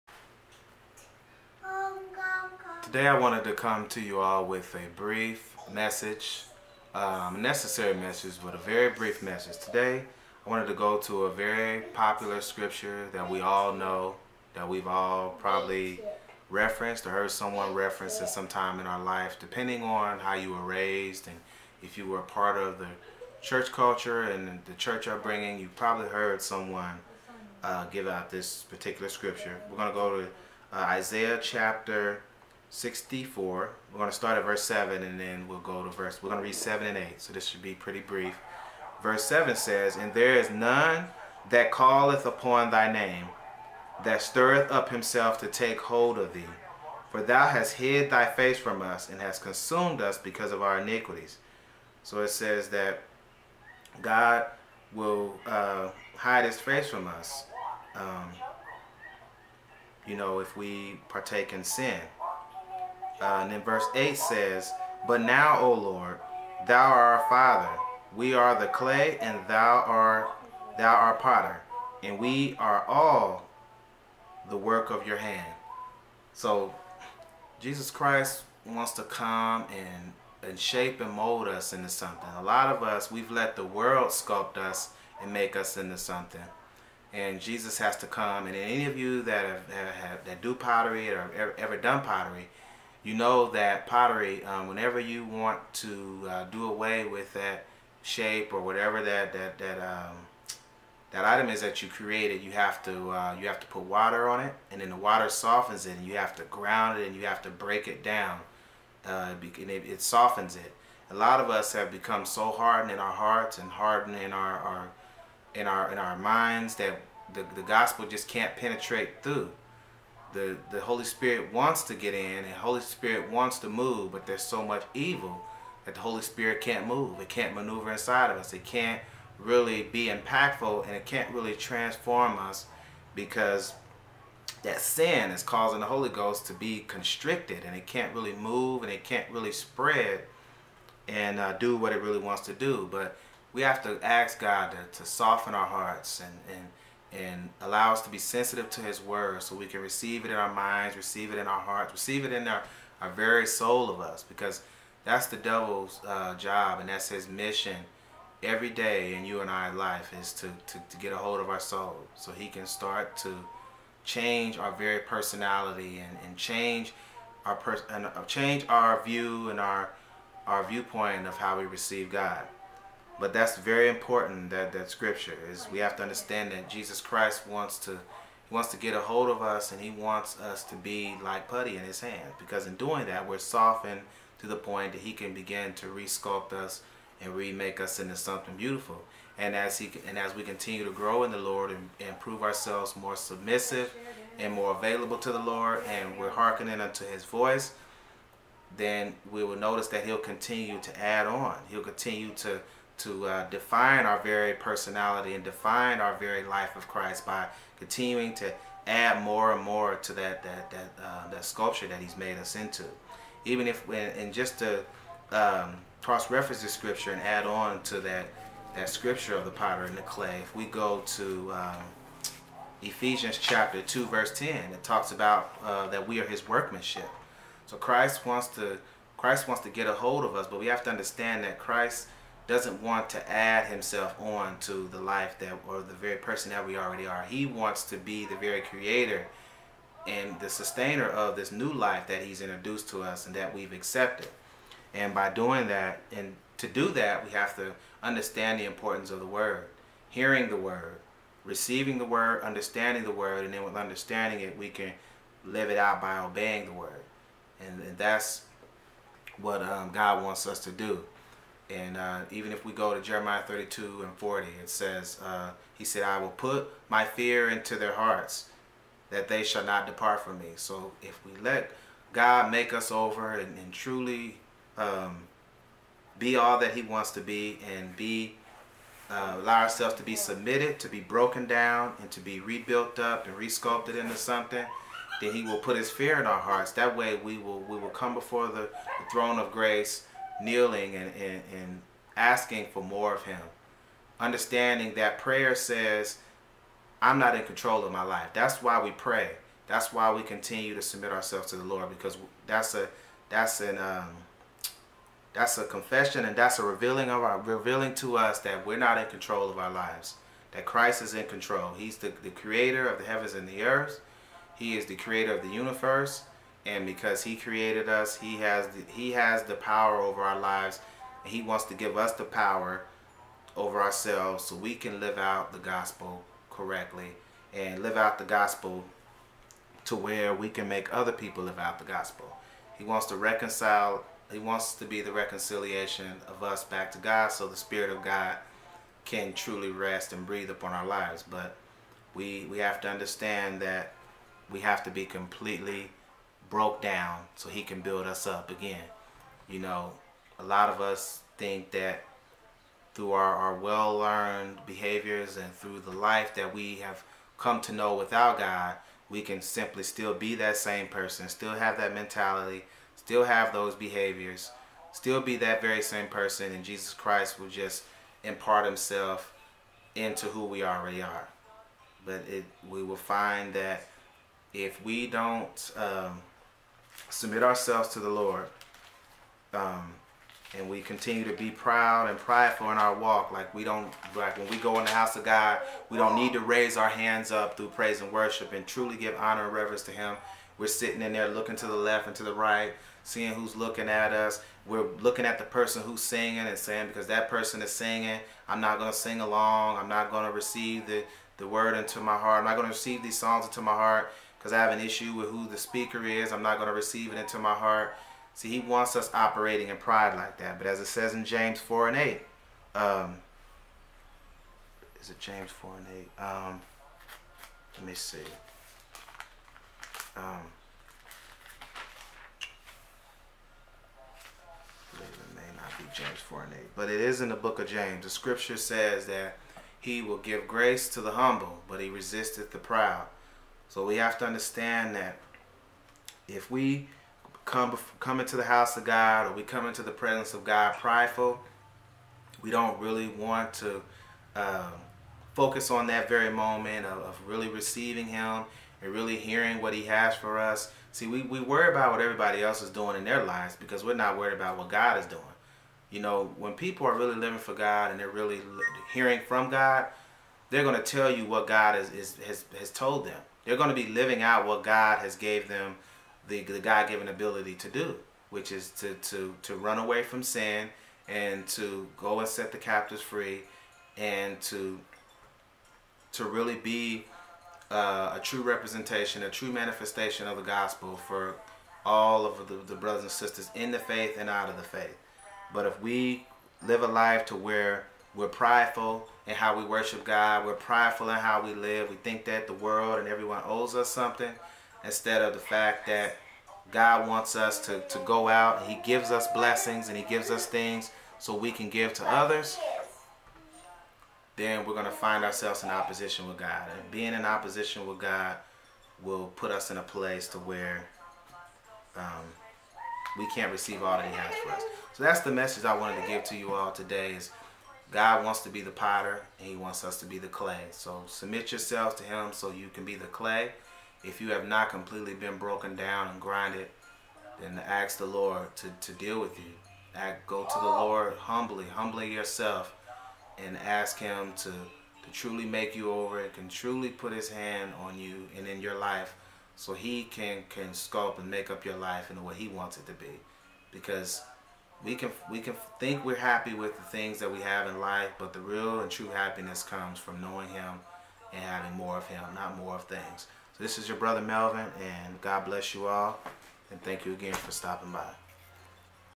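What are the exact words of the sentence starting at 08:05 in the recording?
But if we live a life to where we're prideful, and how we worship God.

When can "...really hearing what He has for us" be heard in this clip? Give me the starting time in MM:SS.
07:28.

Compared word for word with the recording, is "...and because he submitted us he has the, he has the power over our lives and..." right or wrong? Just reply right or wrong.
wrong.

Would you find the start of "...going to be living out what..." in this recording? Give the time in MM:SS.
07:43.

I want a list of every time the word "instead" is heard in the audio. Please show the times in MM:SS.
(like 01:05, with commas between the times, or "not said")
08:14.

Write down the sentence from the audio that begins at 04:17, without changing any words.
And, and that's what um, God wants us to do.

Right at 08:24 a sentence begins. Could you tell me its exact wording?
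Then we're going to find ourselves in opposition with God.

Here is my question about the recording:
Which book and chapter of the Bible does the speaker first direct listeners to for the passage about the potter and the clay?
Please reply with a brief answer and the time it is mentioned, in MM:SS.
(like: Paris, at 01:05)
Isaiah 64, at 00:30.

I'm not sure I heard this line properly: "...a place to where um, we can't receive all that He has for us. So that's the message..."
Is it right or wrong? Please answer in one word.
right.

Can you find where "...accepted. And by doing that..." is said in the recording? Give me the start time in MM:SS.
04:03.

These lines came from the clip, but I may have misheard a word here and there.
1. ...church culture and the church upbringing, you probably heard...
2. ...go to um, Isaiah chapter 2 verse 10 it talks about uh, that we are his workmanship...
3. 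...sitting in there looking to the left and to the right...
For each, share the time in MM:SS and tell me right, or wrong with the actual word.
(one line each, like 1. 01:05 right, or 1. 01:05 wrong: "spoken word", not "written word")
1. 00:23 right
2. 03:40 wrong: "Ephesians", not "Isaiah"
3. 06:30 right.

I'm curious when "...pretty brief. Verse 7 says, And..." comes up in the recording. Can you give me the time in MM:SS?
00:37.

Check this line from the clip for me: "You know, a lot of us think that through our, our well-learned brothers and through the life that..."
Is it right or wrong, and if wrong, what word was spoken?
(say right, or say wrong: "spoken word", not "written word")
wrong: "behaviors", not "brothers".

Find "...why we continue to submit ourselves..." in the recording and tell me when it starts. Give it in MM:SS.
04:59.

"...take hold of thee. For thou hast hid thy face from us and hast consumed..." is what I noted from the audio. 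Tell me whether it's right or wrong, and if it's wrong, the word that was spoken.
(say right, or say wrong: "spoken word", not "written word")
right.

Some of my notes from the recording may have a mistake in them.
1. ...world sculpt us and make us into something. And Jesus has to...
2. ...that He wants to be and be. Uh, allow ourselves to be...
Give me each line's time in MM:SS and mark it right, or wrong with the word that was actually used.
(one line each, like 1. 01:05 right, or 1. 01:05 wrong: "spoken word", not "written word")
1. 01:23 right
2. 04:36 right.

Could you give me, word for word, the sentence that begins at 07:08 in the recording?
The scripture says that he will give grace to the humble, but he resisteth the proud.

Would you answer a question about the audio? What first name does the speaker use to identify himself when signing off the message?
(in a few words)
Melvin.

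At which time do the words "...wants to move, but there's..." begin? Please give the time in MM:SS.
02:03.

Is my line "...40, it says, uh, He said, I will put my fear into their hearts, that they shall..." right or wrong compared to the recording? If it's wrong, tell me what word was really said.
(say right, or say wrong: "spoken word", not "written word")
right.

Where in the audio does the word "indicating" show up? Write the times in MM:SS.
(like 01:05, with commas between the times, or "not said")
not said.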